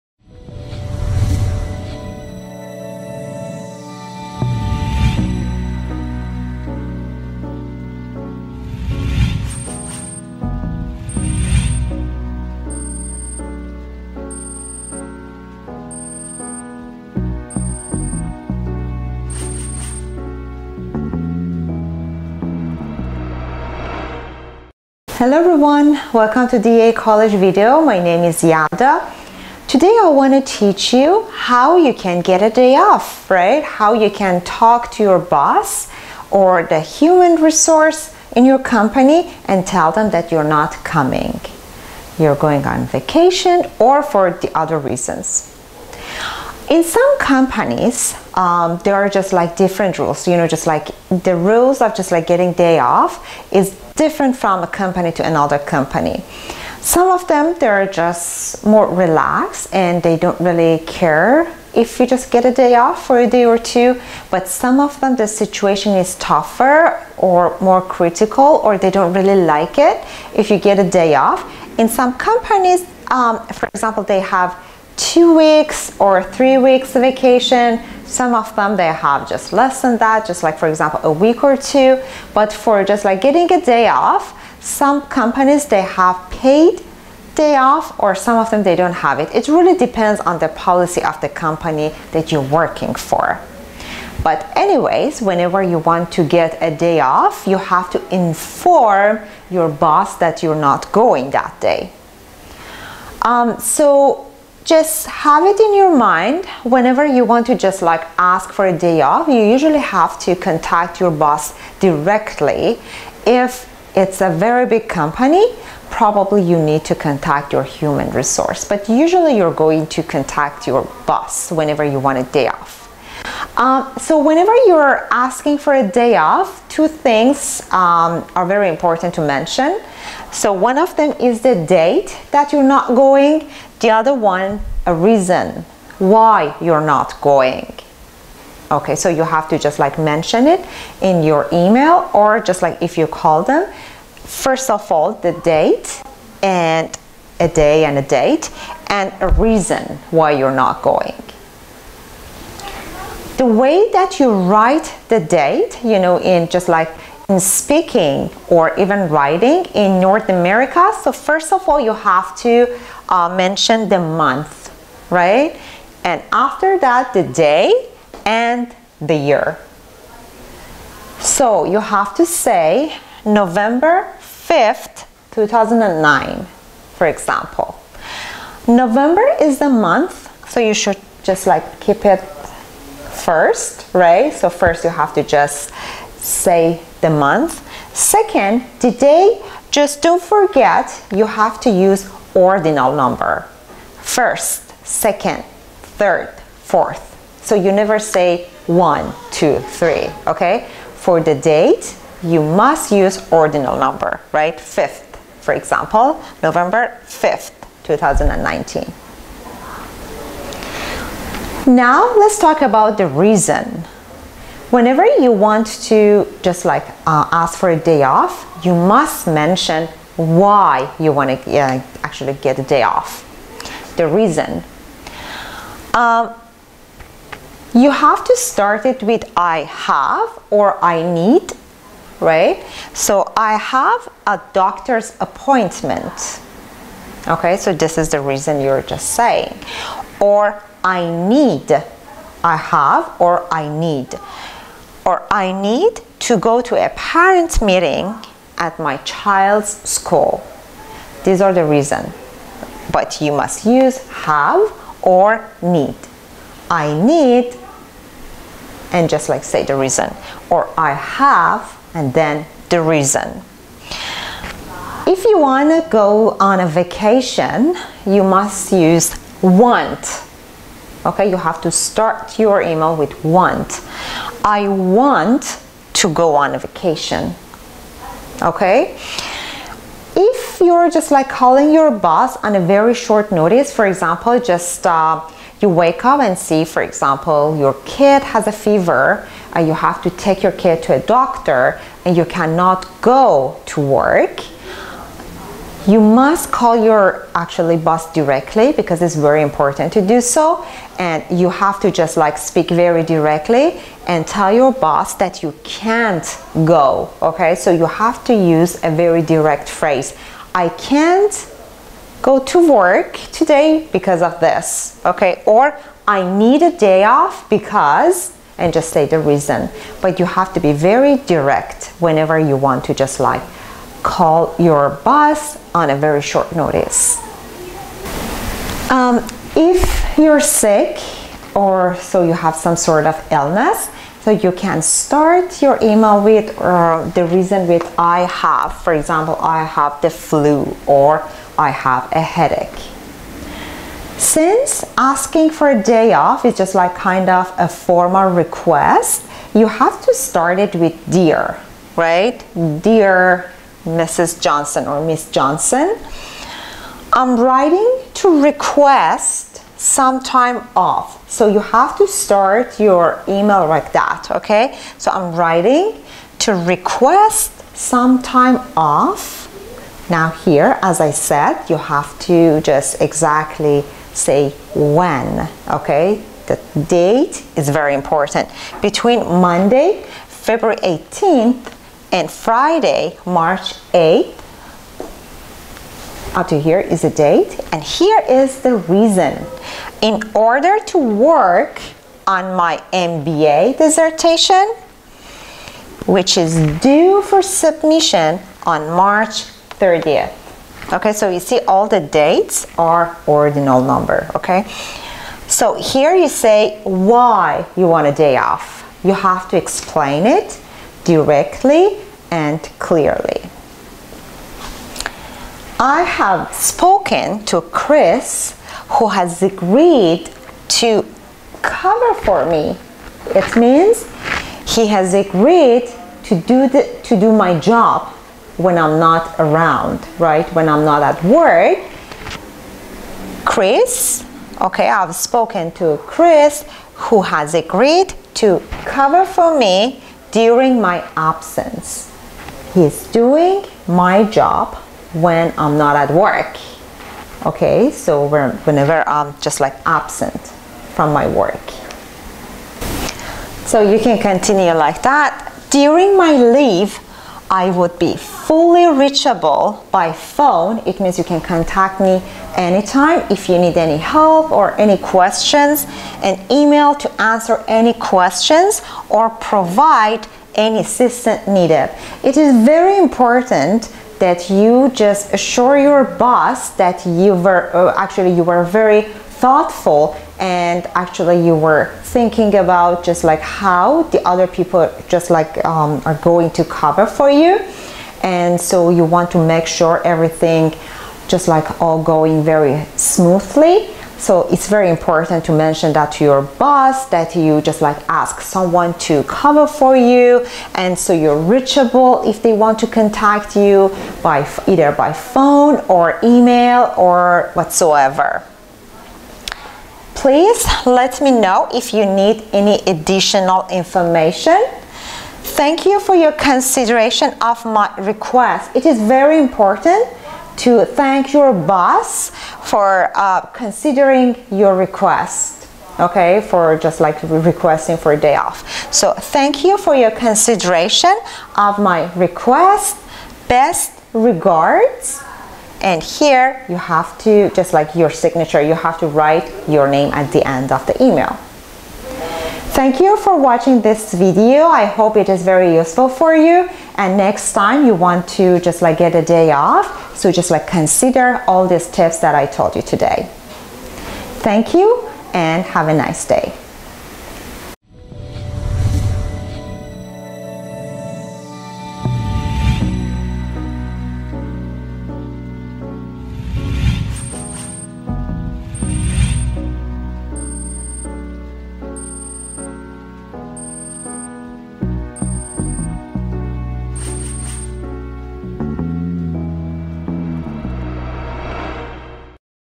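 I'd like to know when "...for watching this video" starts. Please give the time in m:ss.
9:03.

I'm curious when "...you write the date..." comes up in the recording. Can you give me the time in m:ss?
2:34.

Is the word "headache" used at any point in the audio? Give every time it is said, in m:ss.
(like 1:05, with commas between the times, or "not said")
5:42.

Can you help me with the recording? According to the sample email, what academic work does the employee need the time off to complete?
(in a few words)
MBA dissertation.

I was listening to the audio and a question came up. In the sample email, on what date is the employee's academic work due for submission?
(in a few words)
March 30th.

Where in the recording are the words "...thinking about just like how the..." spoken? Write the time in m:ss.
8:02.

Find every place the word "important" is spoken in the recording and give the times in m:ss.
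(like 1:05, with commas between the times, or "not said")
2:08, 4:59, 6:17, 7:52, 8:14, 8:39.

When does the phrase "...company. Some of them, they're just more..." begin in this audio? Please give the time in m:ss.
0:55.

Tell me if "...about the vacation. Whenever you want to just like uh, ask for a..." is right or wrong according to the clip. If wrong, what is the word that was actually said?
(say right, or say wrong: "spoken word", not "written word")
wrong: "reason", not "vacation".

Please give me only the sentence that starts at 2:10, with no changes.
So one of them is the date that you're not going.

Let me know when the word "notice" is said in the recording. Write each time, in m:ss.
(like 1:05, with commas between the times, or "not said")
4:43, 5:26.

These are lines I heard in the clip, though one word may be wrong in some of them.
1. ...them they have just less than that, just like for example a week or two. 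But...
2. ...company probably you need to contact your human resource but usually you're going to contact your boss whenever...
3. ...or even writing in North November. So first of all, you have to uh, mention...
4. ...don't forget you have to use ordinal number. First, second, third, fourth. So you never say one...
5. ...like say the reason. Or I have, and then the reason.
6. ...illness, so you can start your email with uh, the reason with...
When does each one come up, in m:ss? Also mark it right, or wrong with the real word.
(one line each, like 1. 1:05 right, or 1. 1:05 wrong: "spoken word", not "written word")
1. 1:18 right
2. 1:54 right
3. 2:38 wrong: "America", not "November"
4. 3:10 right
5. 4:19 right
6. 5:33 right.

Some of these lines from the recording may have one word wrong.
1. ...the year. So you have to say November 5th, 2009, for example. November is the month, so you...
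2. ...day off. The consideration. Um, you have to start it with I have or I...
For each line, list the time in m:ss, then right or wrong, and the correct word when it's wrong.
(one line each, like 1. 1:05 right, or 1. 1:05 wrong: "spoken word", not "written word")
1. 2:48 right
2. 3:42 wrong: "reason", not "consideration".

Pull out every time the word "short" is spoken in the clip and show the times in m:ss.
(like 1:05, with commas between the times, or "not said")
4:42, 5:26.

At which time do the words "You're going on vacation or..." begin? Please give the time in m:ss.
0:42.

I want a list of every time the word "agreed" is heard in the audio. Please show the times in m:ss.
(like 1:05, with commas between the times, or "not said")
6:59, 7:05, 7:17.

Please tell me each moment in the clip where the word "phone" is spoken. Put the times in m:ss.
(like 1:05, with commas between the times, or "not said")
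7:40, 8:25.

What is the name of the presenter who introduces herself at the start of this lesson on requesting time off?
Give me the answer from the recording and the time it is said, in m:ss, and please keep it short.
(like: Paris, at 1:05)
Yada, at 0:28.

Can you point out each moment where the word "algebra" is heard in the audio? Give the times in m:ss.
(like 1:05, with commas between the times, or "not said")
not said.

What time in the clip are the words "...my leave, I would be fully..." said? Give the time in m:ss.
7:36.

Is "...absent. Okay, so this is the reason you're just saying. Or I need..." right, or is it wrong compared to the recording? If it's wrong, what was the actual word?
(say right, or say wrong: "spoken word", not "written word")
wrong: "appointment", not "absent".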